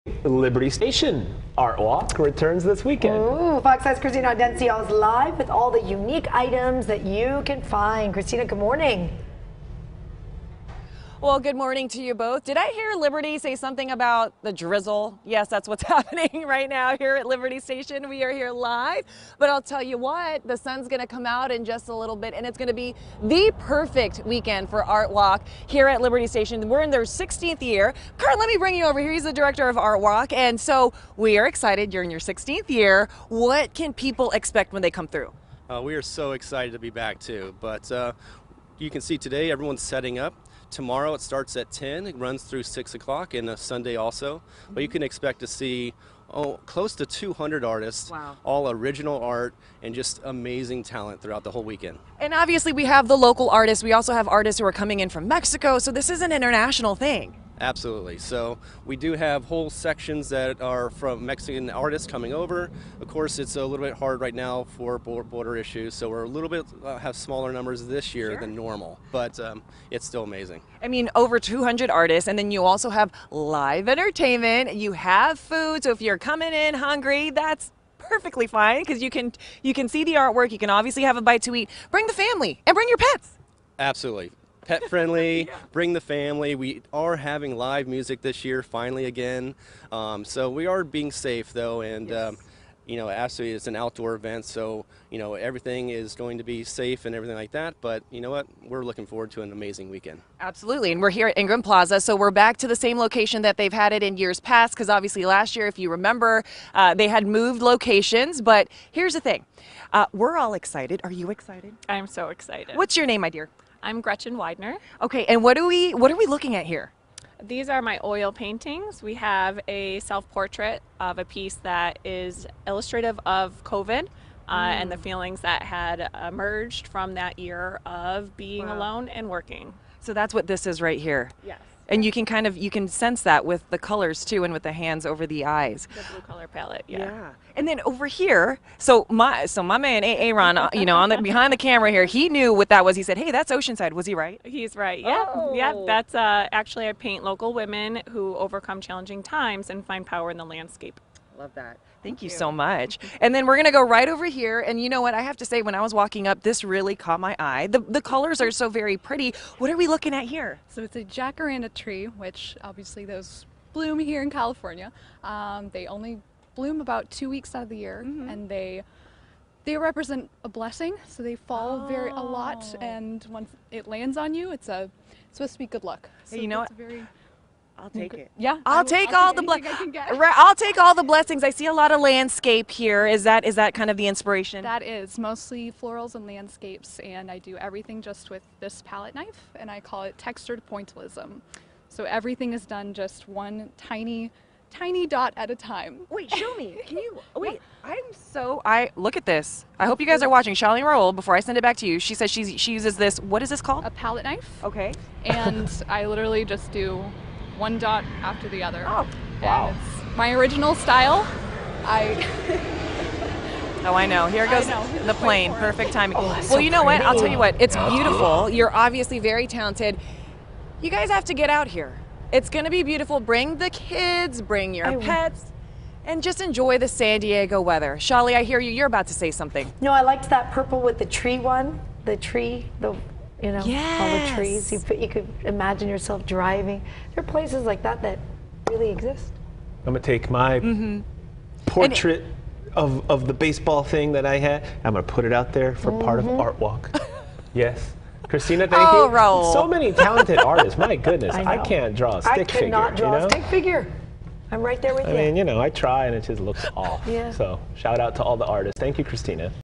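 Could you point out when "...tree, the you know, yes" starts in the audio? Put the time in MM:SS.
03:52.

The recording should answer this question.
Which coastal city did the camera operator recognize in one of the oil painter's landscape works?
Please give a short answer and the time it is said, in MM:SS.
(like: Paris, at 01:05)
Oceanside, at 02:23.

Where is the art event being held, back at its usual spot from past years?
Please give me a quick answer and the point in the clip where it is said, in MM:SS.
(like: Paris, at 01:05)
Ingram Plaza, at 01:41.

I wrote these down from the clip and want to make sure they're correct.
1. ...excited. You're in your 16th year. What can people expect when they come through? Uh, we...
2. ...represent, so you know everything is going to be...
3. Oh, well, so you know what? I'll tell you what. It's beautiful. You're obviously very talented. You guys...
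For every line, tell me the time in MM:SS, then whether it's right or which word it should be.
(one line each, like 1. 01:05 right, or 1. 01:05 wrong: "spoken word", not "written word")
1. 00:31 right
2. 01:34 wrong: "event", not "represent"
3. 03:36 right.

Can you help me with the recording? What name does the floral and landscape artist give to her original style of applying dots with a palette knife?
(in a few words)
textured pointillism.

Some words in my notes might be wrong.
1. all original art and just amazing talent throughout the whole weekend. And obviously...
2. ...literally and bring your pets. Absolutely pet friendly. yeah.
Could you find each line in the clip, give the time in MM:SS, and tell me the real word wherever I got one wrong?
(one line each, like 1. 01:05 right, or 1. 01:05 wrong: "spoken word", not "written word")
1. 00:48 right
2. 01:22 wrong: "family", not "literally".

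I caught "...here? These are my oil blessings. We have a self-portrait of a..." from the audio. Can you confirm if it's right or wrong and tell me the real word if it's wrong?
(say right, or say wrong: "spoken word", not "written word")
wrong: "paintings", not "blessings".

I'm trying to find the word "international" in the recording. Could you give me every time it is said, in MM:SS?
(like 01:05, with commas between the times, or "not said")
00:56.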